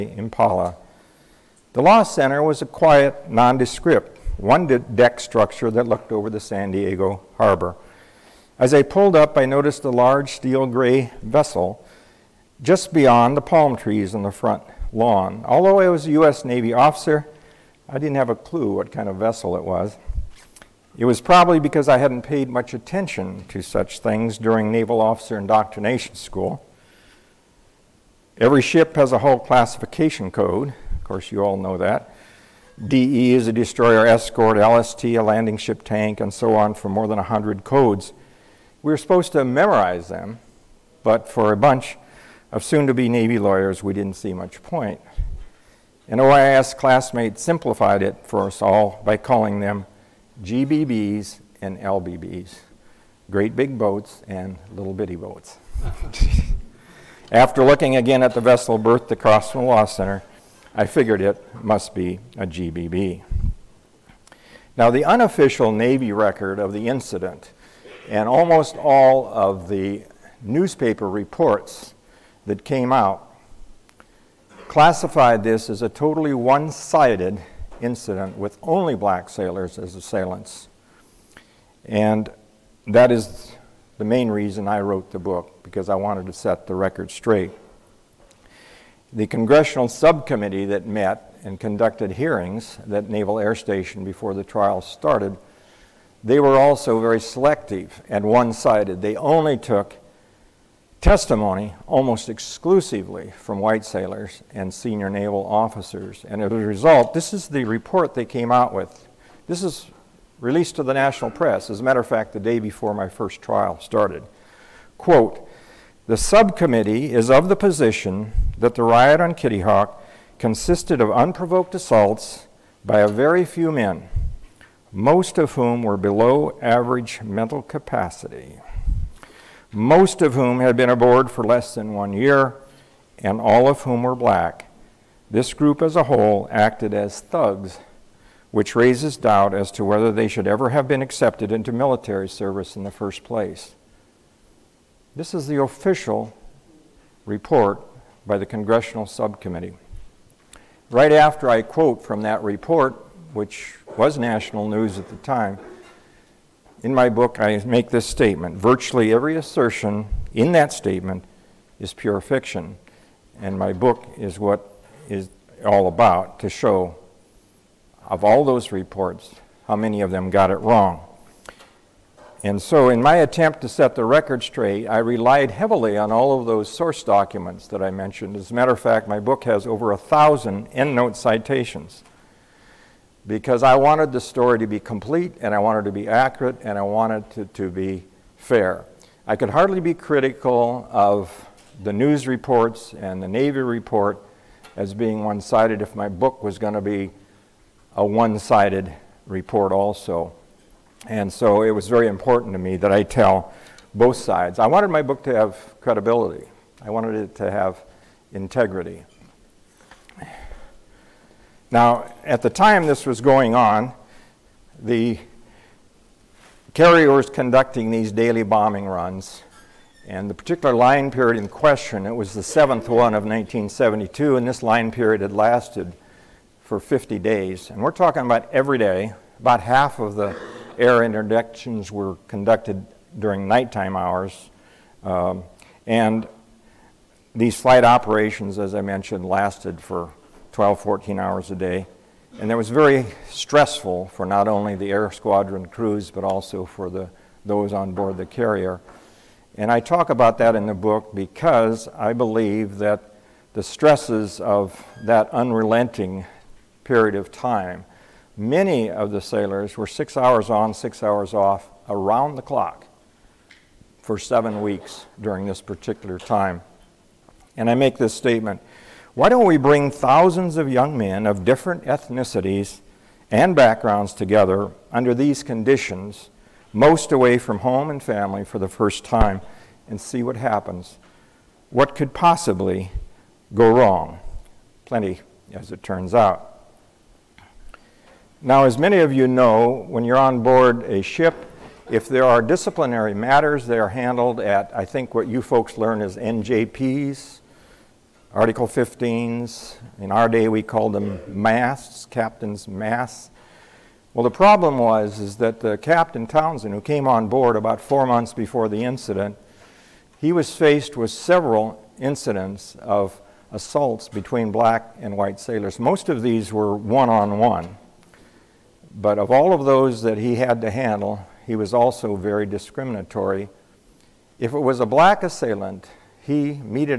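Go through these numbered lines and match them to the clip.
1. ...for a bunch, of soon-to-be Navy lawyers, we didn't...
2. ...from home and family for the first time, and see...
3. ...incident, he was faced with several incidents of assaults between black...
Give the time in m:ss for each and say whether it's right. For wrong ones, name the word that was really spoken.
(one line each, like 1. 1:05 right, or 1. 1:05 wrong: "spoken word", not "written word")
1. 0:41 right
2. 4:37 right
3. 5:08 right.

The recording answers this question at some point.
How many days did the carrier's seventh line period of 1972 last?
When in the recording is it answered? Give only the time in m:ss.
3:46.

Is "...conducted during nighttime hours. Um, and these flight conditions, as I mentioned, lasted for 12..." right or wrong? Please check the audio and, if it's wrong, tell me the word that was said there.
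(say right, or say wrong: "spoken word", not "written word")
wrong: "operations", not "conditions".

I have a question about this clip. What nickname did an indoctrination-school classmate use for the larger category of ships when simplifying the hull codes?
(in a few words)
GBBs.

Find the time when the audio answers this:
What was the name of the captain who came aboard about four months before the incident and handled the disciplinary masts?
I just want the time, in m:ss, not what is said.
5:05.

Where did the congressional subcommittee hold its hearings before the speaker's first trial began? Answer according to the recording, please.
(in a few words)
Naval Air Station.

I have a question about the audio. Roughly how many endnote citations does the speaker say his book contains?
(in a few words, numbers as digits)
over 1000.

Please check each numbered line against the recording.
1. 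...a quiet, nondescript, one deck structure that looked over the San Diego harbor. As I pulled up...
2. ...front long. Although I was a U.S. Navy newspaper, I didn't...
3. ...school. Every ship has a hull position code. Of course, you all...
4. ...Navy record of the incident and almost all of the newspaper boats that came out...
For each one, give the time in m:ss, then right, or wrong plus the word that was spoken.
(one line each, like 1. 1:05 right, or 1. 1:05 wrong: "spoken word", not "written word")
1. 0:02 right
2. 0:14 wrong: "officer", not "newspaper"
3. 0:26 wrong: "classification", not "position"
4. 1:05 wrong: "reports", not "boats".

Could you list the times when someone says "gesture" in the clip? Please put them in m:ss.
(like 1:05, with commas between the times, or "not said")
not said.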